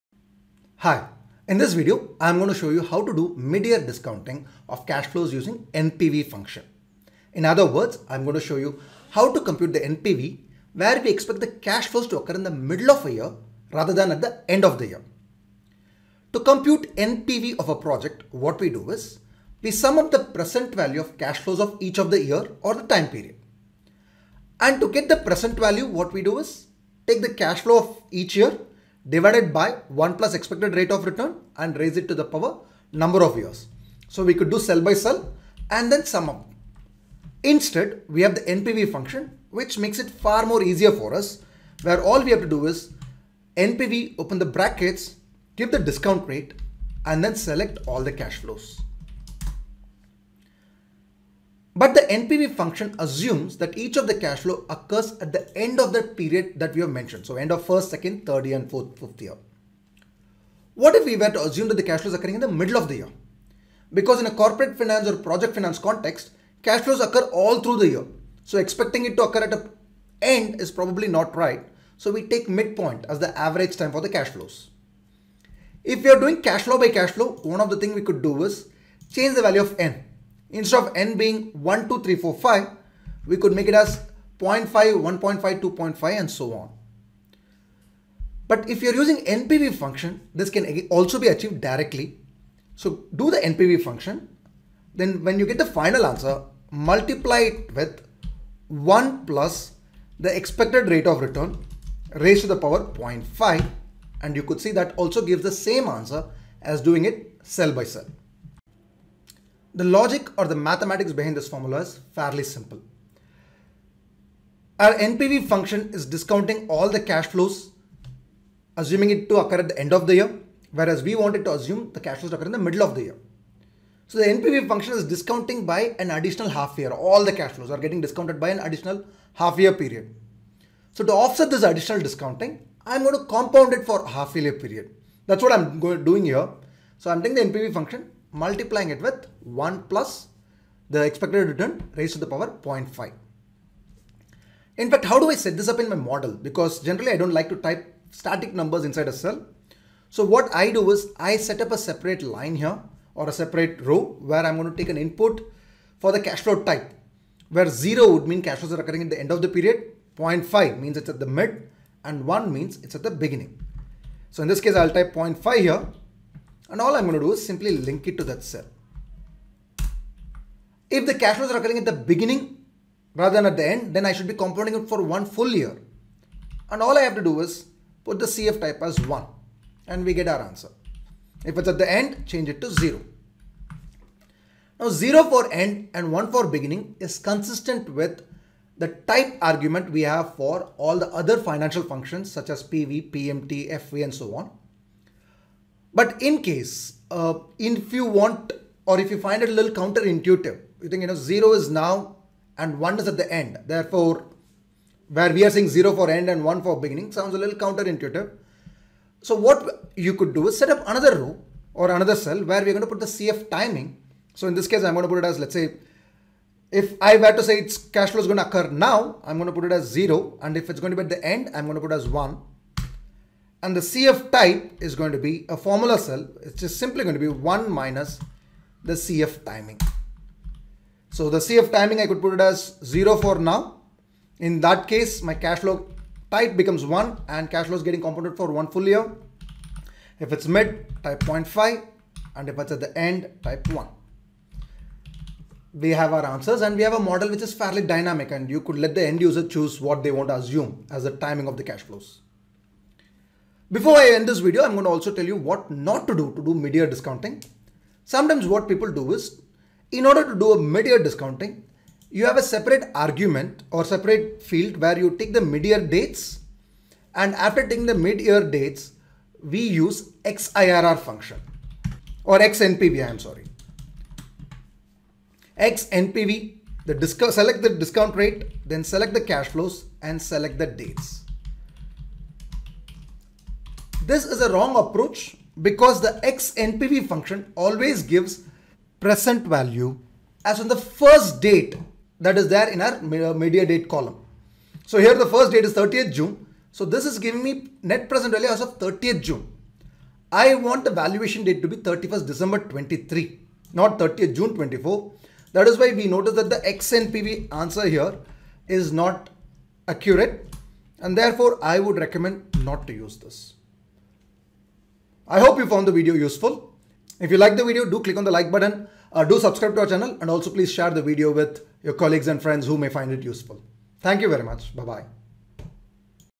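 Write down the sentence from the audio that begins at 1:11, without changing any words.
So we take midpoint as the average time for the cash flows.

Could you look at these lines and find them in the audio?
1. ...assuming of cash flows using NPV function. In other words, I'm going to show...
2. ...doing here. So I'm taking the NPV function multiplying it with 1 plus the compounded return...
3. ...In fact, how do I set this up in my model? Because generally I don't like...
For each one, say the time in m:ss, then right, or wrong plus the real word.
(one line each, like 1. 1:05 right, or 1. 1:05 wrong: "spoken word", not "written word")
1. 0:03 wrong: "discounting", not "assuming"
2. 2:16 wrong: "expected", not "compounded"
3. 2:24 right.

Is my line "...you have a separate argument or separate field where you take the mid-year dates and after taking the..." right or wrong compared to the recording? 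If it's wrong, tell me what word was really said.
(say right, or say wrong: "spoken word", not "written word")
right.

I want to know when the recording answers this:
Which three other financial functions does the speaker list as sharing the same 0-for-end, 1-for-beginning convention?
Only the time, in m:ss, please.
3:12.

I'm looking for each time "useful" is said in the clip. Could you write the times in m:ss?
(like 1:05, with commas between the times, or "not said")
5:16, 5:23.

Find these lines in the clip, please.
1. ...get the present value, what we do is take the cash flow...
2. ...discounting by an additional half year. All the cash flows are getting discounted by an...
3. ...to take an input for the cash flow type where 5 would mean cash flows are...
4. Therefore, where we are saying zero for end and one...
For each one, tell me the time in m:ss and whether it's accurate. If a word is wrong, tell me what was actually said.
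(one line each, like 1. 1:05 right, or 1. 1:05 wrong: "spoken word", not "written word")
1. 0:24 right
2. 2:05 right
3. 2:34 wrong: "0", not "5"
4. 3:23 right.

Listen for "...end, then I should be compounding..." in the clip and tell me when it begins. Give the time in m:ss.
2:53.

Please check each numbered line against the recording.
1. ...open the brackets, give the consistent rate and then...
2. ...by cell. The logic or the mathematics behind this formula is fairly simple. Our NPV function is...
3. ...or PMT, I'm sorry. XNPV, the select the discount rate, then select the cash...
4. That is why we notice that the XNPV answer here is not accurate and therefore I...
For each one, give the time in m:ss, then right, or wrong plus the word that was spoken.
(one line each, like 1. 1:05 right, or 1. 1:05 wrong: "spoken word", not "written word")
1. 0:44 wrong: "discount", not "consistent"
2. 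1:47 right
3. 4:32 wrong: "XNPV", not "PMT"
4. 5:05 right.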